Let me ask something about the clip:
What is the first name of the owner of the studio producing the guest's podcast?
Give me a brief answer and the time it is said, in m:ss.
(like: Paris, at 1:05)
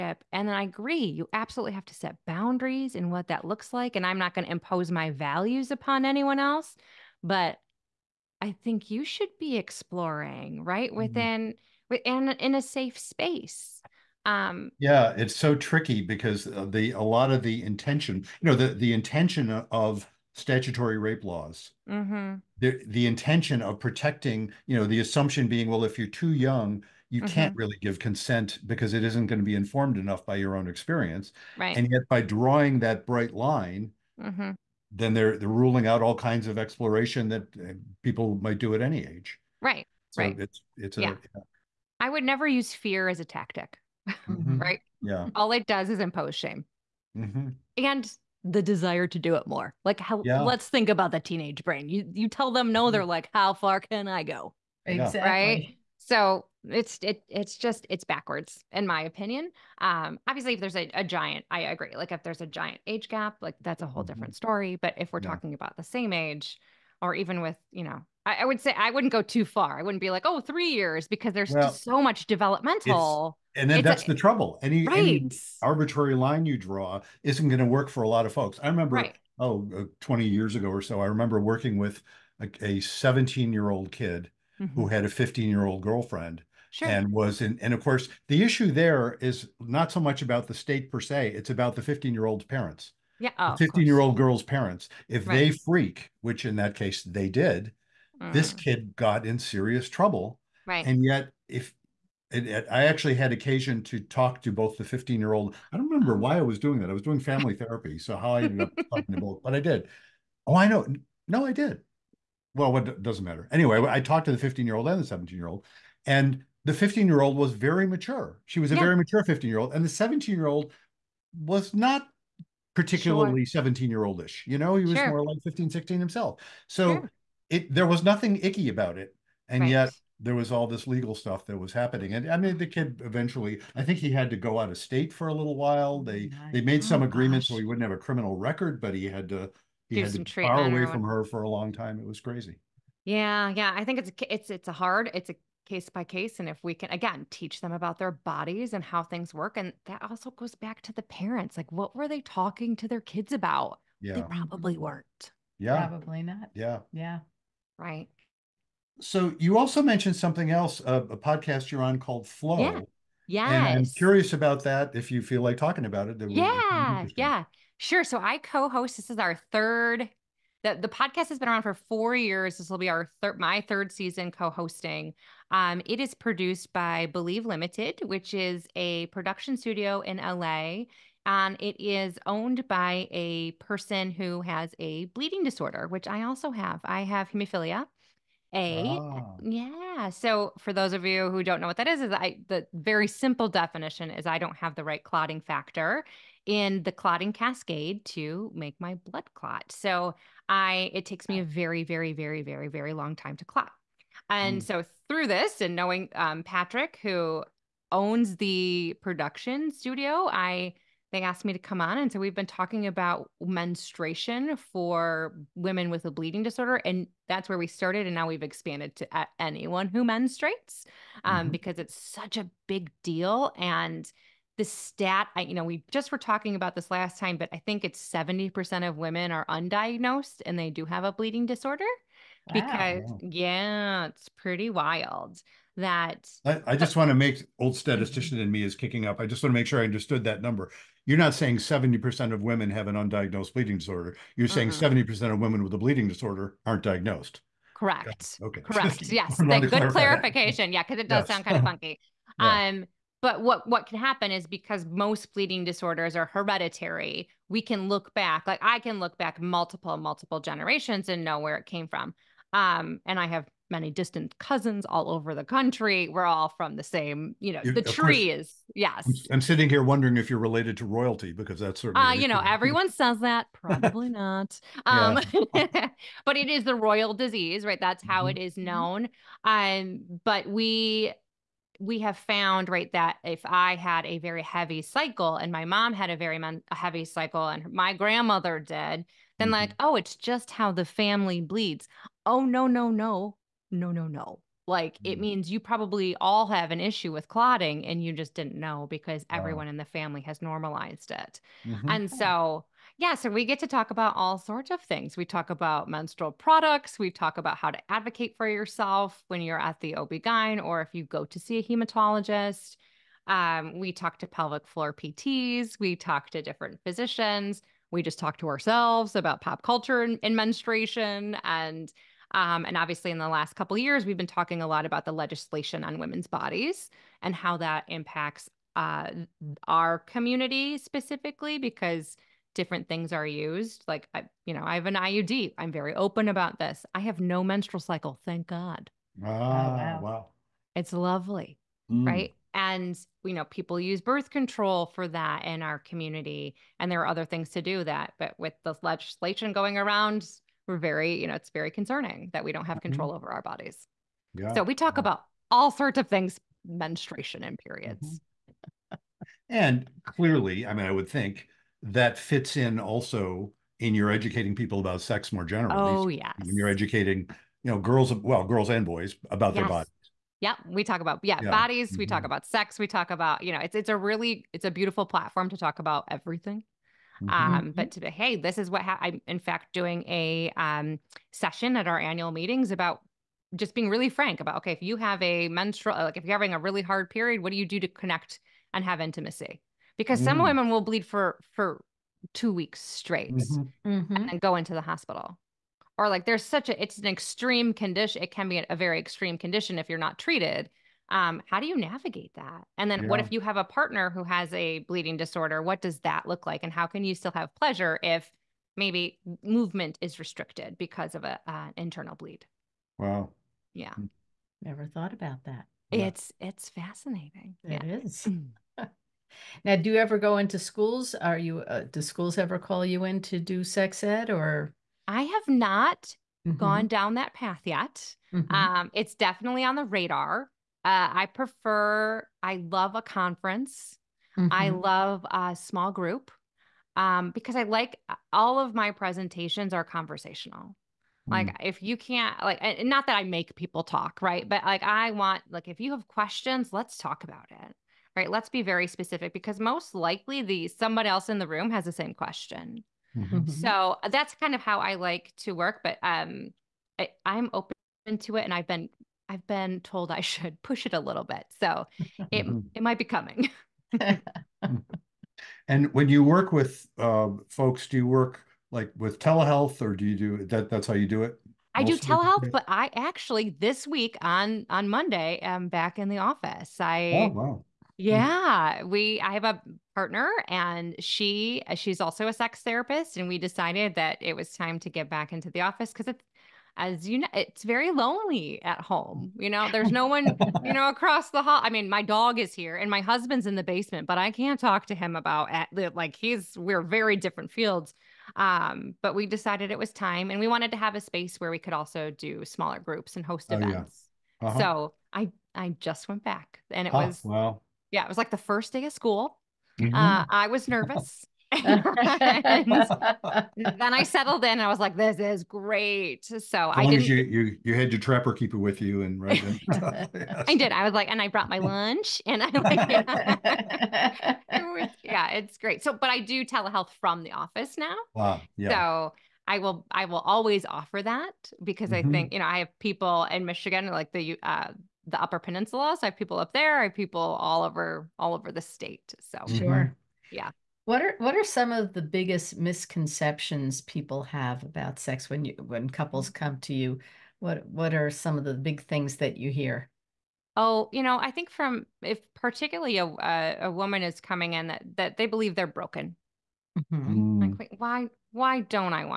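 Patrick, at 3:26.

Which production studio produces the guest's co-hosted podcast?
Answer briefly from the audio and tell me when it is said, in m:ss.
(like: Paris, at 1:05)
Believe Limited, at 2:57.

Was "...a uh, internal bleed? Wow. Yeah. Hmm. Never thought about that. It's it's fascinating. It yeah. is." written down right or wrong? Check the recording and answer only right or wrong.
right.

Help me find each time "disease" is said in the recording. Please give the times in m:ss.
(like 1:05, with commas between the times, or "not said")
4:37.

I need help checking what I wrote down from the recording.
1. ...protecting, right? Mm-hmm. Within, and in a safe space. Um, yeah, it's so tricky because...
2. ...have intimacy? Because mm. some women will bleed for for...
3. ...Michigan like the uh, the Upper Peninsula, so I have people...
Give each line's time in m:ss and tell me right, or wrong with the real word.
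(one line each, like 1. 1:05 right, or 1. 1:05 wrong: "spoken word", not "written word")
1. 0:09 wrong: "exploring", not "protecting"
2. 6:28 right
3. 8:53 right.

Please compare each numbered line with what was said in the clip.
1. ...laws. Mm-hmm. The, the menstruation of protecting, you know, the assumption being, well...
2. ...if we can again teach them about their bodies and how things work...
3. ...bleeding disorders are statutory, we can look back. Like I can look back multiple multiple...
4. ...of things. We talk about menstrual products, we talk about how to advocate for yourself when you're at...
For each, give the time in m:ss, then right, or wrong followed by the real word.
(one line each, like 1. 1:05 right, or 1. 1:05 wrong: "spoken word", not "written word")
1. 0:21 wrong: "intention", not "menstruation"
2. 2:26 right
3. 4:15 wrong: "hereditary", not "statutory"
4. 5:04 right.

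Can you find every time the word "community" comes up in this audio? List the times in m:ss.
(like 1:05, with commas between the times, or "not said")
5:29, 5:45.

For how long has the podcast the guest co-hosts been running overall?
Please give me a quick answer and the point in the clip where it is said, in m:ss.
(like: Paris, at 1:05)
4 years, at 2:51.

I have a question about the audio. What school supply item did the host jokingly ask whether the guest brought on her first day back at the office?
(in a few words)
Trapper keeper.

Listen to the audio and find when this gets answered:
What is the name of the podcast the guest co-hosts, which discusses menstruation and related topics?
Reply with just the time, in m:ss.
2:42.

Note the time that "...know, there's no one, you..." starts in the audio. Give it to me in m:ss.
8:09.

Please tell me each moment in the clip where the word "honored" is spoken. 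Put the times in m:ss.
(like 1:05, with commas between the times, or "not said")
not said.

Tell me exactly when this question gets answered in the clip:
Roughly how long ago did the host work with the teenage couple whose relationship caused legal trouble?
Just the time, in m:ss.
1:19.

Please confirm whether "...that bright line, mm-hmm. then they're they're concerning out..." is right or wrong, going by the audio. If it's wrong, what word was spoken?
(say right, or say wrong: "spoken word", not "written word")
wrong: "ruling", not "concerning".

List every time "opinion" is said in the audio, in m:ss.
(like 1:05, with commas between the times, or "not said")
0:59.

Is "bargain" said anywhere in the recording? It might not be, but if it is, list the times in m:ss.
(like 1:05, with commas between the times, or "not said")
not said.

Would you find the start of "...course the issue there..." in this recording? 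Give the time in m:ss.
1:27.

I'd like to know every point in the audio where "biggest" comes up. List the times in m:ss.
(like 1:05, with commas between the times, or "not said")
9:02.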